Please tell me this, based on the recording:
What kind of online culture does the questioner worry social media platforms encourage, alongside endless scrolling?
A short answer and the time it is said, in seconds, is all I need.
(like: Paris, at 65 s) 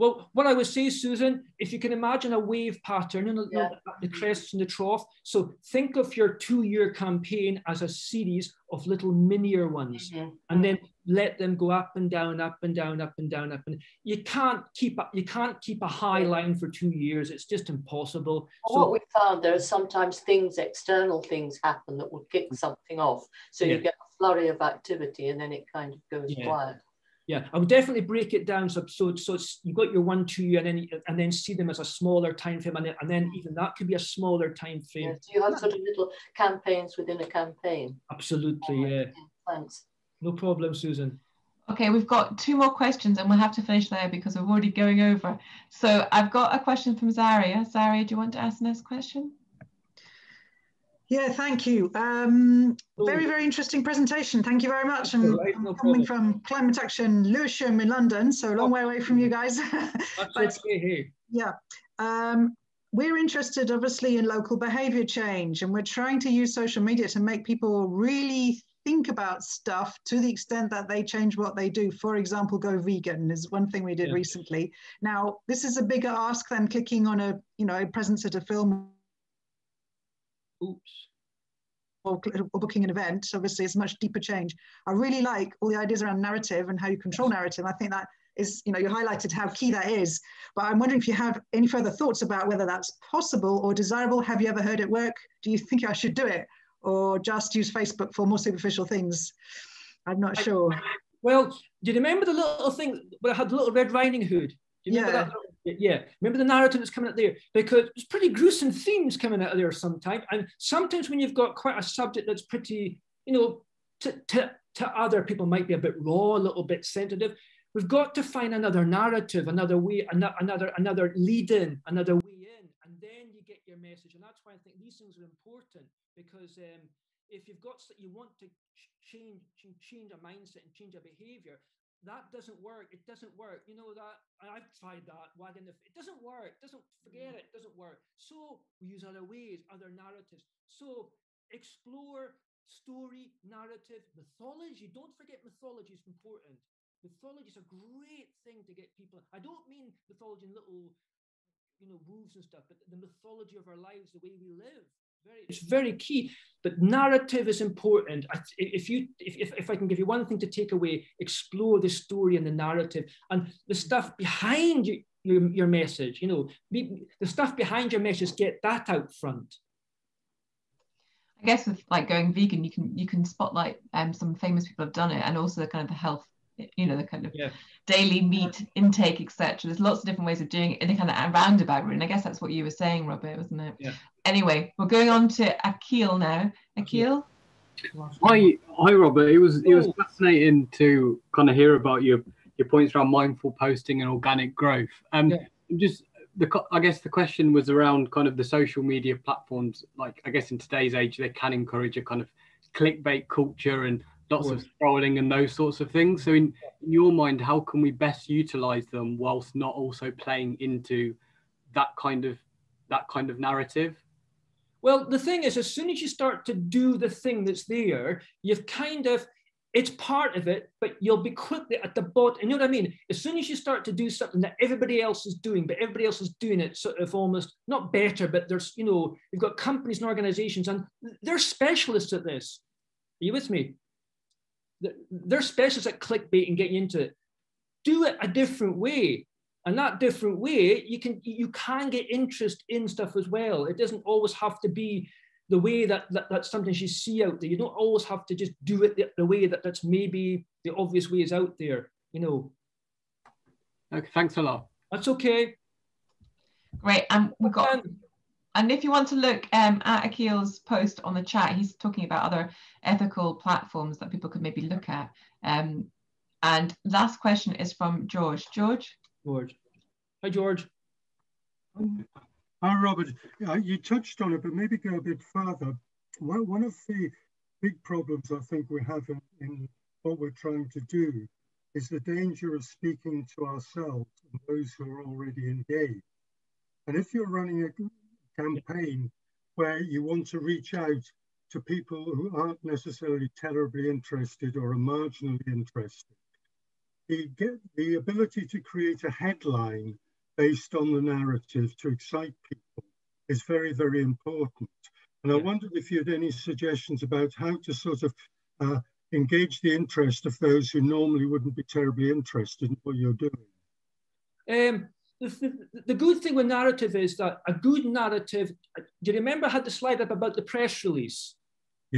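clickbait culture, at 202 s.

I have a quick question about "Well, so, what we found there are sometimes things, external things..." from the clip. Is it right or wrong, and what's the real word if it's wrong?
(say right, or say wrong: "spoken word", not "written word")
right.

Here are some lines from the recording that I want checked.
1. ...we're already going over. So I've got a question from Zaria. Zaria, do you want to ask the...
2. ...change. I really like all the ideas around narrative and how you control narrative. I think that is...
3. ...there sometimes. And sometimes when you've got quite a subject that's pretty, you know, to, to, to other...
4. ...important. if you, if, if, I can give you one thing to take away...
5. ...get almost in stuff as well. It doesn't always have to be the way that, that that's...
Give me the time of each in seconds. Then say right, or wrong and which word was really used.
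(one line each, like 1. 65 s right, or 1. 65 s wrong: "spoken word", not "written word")
1. 44 s right
2. 84 s right
3. 109 s right
4. 157 s right
5. 241 s wrong: "interest", not "almost".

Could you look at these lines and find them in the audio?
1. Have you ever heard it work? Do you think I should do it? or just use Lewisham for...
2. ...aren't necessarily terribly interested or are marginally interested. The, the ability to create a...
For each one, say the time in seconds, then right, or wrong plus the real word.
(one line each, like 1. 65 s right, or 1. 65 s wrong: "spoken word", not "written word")
1. 94 s wrong: "Facebook", not "Lewisham"
2. 292 s right.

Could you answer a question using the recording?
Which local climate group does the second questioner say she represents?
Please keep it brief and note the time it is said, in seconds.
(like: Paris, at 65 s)
Climate Action Lewisham, at 56 s.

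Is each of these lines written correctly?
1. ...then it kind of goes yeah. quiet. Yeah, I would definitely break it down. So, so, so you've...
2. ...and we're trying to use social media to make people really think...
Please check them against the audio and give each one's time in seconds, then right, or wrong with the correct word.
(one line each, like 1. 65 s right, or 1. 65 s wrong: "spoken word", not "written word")
1. 25 s right
2. 65 s right.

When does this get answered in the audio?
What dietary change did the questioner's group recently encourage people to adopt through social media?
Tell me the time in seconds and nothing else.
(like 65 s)
72 s.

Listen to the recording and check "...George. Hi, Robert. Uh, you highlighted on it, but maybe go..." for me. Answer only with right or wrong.
wrong.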